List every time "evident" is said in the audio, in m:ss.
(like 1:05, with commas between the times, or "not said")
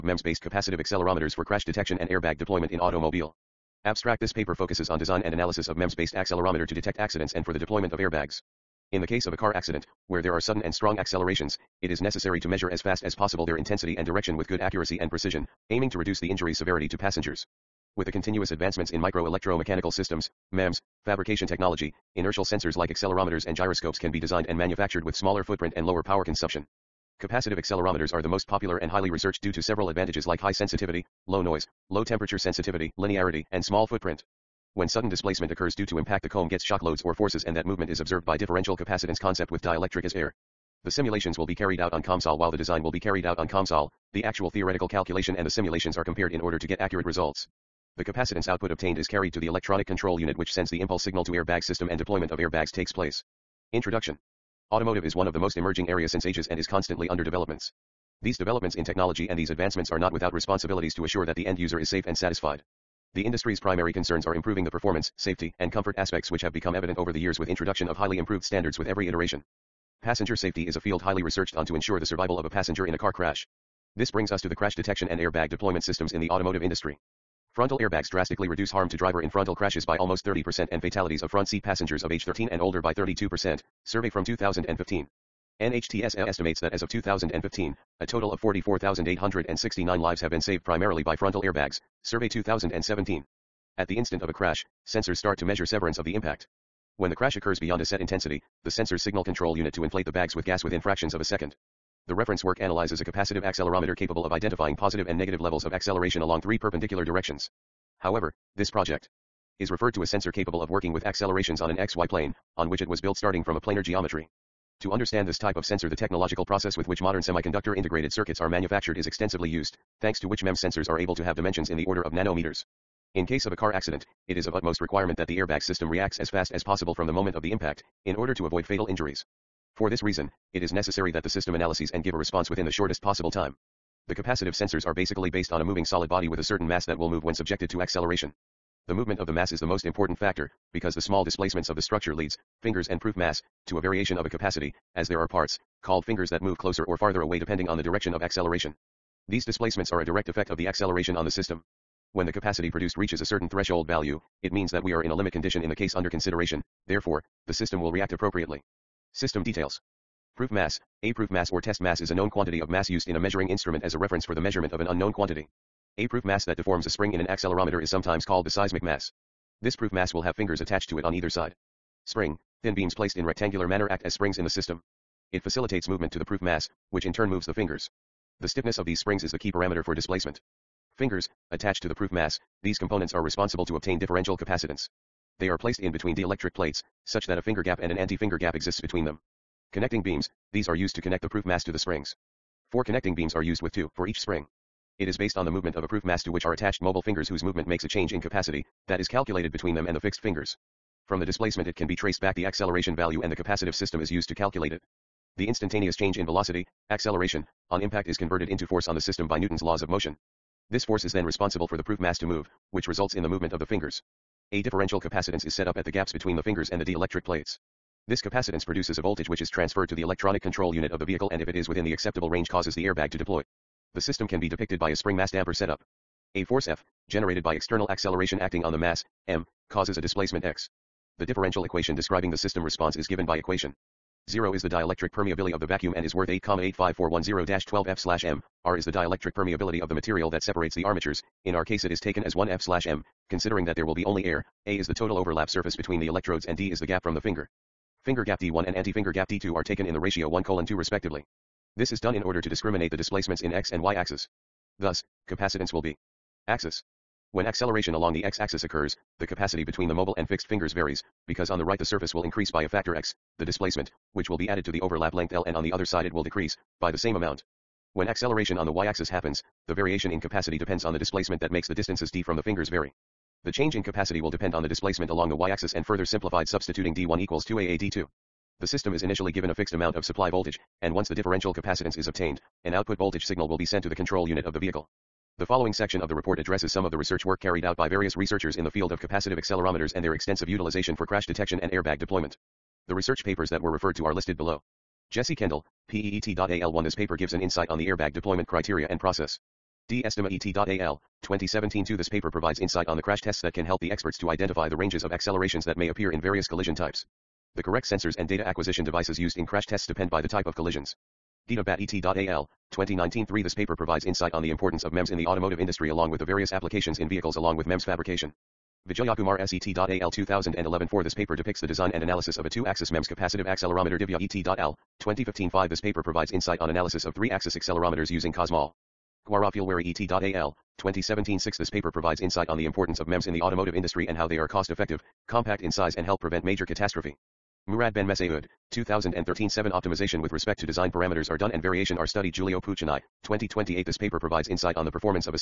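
1:06.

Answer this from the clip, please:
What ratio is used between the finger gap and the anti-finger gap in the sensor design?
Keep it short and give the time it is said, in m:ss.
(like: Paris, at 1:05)
1:2, at 4:10.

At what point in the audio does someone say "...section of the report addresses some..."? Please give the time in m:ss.
4:45.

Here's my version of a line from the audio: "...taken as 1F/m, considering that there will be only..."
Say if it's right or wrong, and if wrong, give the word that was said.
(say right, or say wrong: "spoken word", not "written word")
right.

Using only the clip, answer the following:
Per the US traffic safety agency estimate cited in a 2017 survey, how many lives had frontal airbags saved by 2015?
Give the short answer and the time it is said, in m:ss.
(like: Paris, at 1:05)
44,869, at 1:28.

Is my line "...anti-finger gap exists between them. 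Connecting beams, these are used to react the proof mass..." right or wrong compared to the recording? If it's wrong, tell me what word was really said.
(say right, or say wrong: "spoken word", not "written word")
wrong: "connect", not "react".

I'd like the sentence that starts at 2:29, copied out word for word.
These displacements are a direct effect of the acceleration on the system.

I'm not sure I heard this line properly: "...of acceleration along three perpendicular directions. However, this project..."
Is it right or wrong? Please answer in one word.
right.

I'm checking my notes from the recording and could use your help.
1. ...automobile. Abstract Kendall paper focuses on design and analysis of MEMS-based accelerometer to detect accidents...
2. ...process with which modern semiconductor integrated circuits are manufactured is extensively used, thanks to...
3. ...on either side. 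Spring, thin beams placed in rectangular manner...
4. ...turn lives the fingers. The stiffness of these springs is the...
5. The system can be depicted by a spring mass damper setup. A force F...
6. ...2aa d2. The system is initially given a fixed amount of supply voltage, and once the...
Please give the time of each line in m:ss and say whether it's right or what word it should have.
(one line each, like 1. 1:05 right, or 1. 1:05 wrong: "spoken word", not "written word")
1. 0:02 wrong: "This", not "Kendall"
2. 1:56 right
3. 2:51 right
4. 2:57 wrong: "moves", not "lives"
5. 3:43 right
6. 4:37 right.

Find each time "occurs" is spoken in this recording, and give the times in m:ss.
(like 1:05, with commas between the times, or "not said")
0:35, 1:37, 4:18.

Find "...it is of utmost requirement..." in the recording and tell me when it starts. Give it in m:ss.
2:04.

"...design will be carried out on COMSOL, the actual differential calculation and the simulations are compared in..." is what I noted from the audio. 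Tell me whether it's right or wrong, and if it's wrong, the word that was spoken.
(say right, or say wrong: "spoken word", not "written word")
wrong: "theoretical", not "differential".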